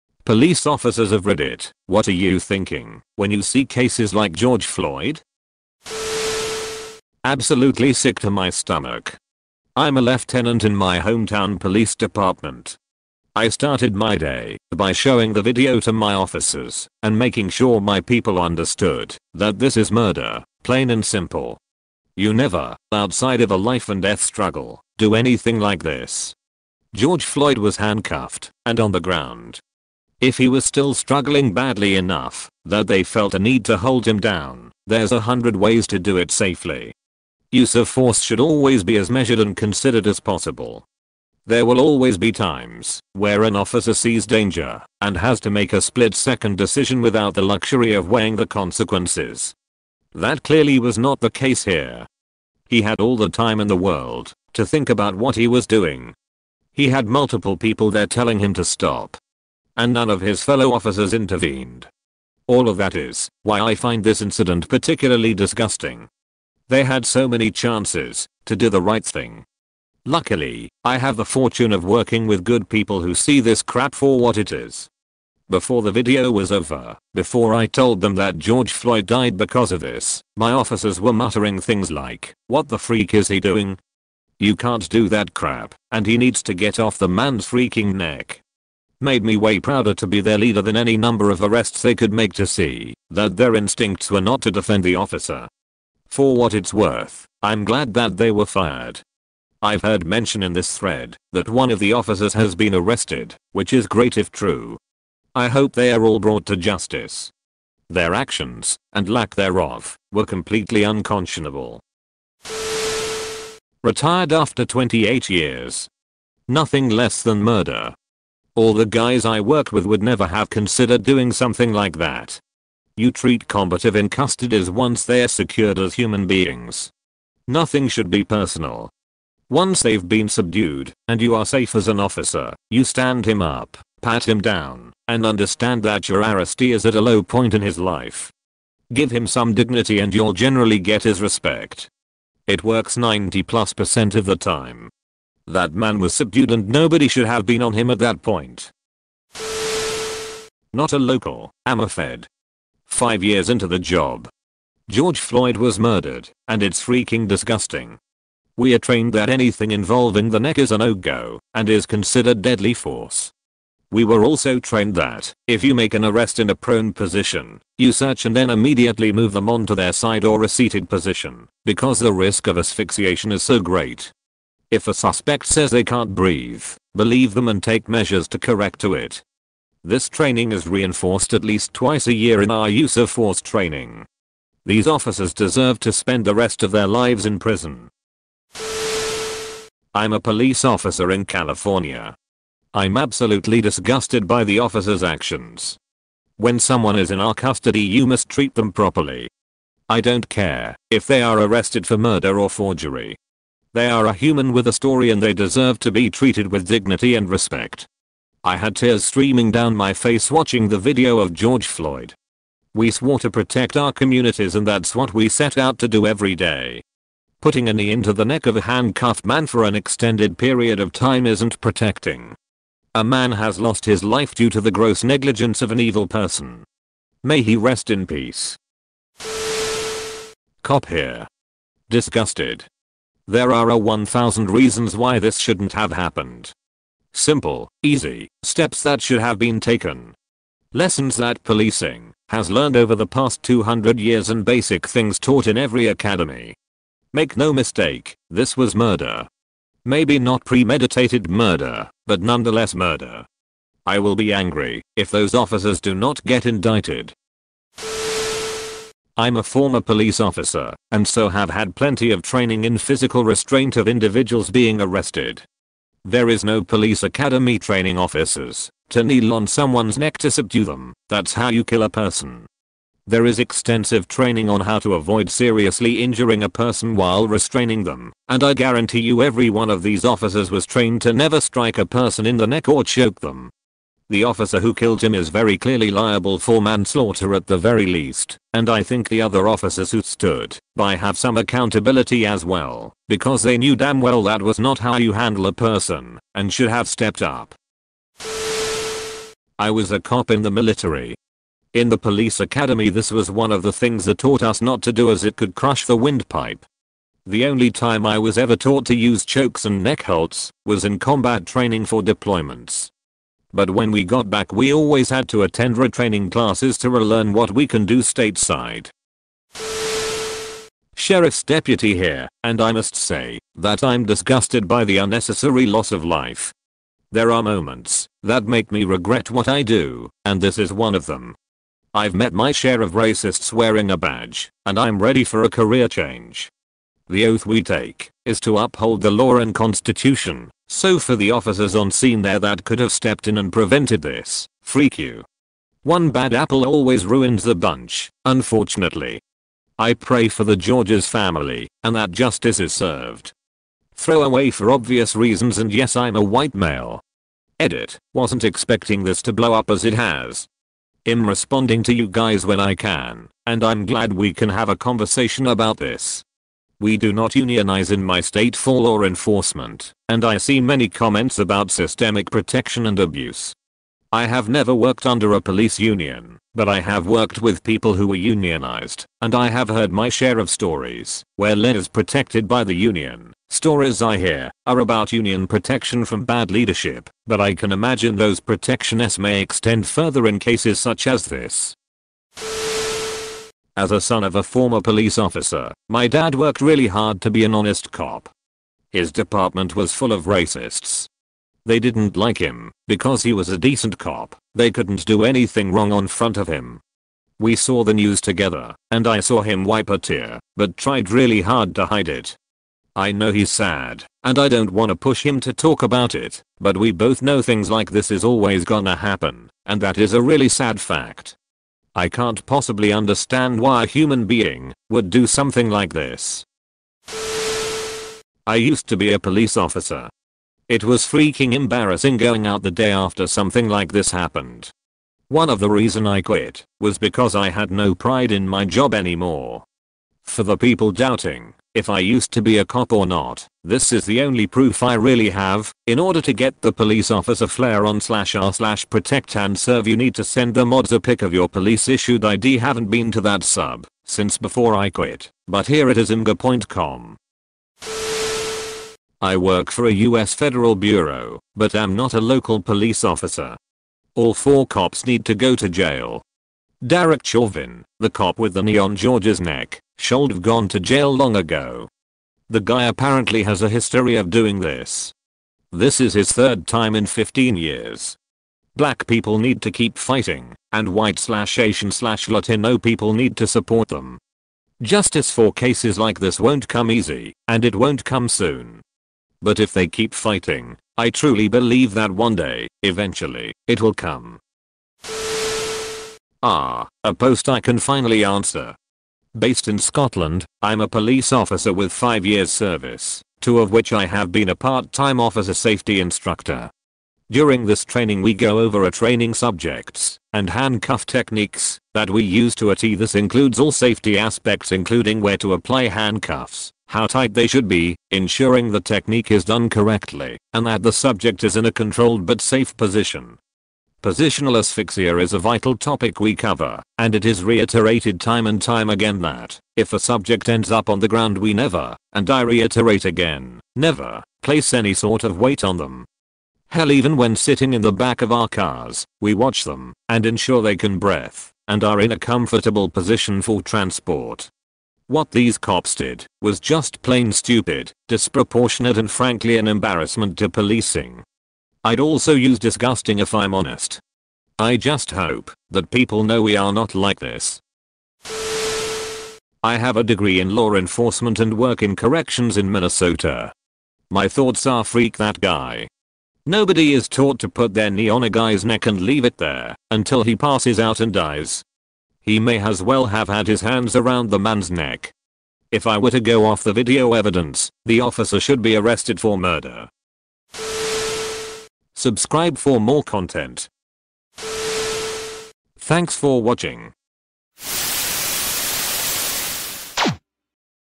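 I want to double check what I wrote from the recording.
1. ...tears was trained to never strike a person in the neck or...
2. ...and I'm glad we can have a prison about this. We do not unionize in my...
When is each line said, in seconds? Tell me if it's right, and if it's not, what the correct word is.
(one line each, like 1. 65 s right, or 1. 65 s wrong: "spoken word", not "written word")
1. 280 s wrong: "officers", not "tears"
2. 363 s wrong: "conversation", not "prison".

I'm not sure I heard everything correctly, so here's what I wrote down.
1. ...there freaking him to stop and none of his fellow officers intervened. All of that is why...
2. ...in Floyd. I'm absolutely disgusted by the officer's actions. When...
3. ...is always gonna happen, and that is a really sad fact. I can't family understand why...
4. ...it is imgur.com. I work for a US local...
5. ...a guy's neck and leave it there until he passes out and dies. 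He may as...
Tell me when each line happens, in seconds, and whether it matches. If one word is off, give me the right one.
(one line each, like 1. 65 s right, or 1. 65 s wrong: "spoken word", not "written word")
1. 57 s wrong: "telling", not "freaking"
2. 191 s wrong: "California", not "Floyd"
3. 418 s wrong: "possibly", not "family"
4. 455 s wrong: "federal", not "local"
5. 568 s right.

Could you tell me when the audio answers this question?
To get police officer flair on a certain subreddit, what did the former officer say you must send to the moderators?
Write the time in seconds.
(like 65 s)
451 s.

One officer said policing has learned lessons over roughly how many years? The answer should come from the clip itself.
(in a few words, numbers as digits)
200 years.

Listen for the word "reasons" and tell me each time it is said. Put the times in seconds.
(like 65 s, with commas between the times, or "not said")
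234 s, 355 s, 435 s.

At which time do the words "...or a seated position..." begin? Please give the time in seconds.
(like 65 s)
170 s.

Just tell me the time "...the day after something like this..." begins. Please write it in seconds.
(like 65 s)
432 s.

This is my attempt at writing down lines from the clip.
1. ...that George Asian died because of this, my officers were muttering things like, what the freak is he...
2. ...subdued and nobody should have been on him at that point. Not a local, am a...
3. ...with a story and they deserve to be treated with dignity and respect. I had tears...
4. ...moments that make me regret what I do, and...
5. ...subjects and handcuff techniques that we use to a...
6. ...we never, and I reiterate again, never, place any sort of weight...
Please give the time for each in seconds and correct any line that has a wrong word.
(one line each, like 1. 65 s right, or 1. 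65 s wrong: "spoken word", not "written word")
1. 78 s wrong: "Floyd", not "Asian"
2. 146 s right
3. 204 s right
4. 327 s right
5. 509 s right
6. 531 s right.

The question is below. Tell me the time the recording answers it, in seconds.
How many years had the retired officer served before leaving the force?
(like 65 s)
114 s.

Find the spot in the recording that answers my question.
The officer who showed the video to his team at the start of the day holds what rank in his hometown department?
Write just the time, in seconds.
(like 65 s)
10 s.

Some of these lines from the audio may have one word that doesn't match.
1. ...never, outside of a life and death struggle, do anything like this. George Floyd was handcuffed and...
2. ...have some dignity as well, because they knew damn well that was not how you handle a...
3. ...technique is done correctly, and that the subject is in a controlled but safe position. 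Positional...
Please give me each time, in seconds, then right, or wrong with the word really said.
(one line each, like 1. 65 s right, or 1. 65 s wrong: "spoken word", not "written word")
1. 22 s right
2. 290 s wrong: "accountability", not "dignity"
3. 518 s right.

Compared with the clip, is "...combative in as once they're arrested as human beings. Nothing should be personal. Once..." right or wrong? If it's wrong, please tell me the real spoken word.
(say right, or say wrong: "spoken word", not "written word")
wrong: "secured", not "arrested".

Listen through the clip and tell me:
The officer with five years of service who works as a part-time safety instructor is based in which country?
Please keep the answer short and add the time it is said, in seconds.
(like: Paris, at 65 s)
Scotland, at 499 s.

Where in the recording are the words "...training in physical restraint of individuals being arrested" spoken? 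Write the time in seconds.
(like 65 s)
262 s.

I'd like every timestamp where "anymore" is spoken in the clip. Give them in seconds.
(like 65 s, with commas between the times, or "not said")
438 s.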